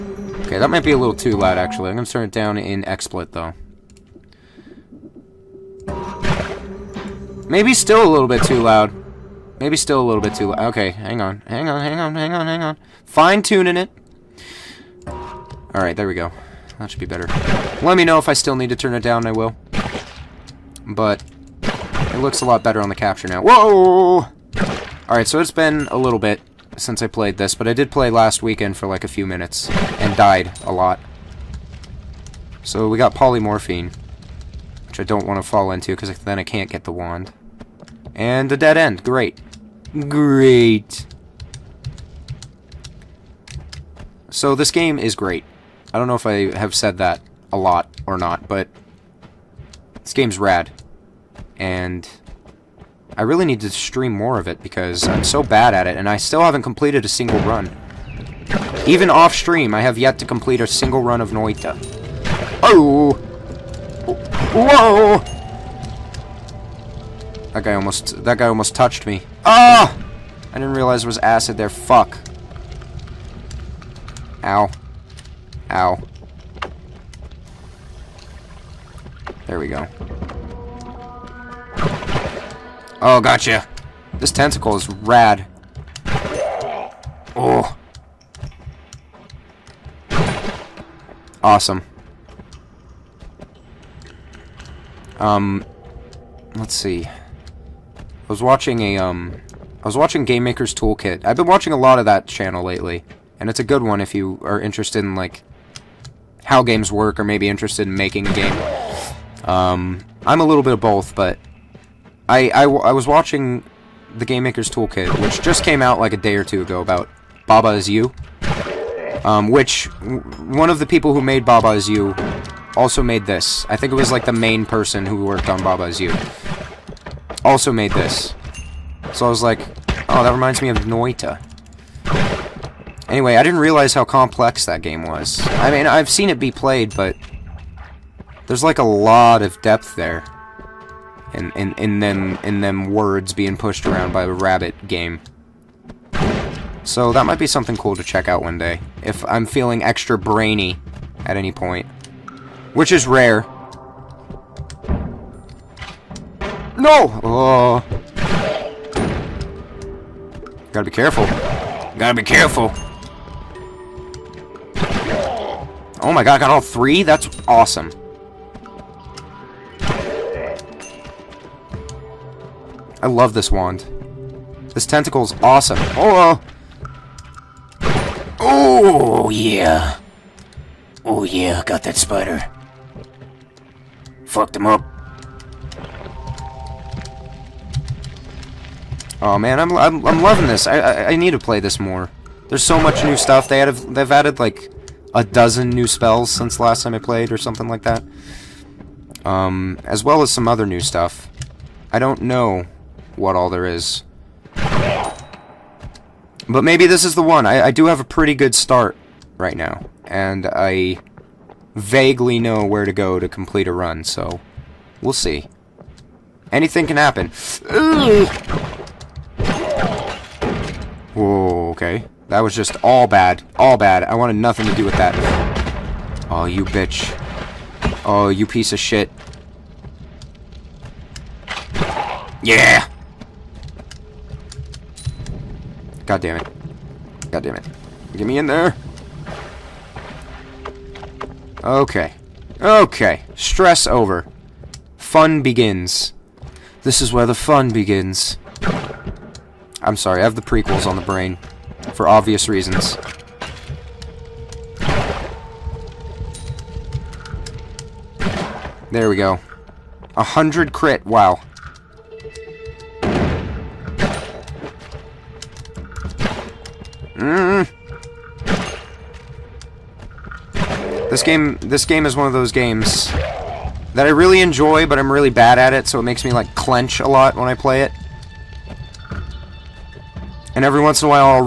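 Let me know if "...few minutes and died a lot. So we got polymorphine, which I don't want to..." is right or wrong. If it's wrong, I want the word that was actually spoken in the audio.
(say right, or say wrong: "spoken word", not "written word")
right.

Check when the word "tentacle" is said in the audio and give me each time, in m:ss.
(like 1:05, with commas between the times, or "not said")
1:24, 2:54.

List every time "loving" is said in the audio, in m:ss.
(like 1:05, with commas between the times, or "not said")
3:10.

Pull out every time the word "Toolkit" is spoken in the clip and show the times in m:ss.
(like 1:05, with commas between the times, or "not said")
1:40, 1:54.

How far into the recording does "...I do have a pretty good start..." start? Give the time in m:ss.
3:27.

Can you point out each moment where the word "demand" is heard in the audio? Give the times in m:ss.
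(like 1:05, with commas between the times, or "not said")
not said.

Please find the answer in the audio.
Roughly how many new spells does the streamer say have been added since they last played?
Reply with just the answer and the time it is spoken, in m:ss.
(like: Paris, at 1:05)
a dozen, at 3:15.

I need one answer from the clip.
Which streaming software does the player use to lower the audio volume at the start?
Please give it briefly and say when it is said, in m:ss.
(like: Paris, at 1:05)
XSplit, at 0:02.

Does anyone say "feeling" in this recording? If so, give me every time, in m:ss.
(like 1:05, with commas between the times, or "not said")
2:29.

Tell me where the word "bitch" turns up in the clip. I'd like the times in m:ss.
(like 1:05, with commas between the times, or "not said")
3:46.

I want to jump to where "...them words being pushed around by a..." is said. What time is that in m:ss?
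2:22.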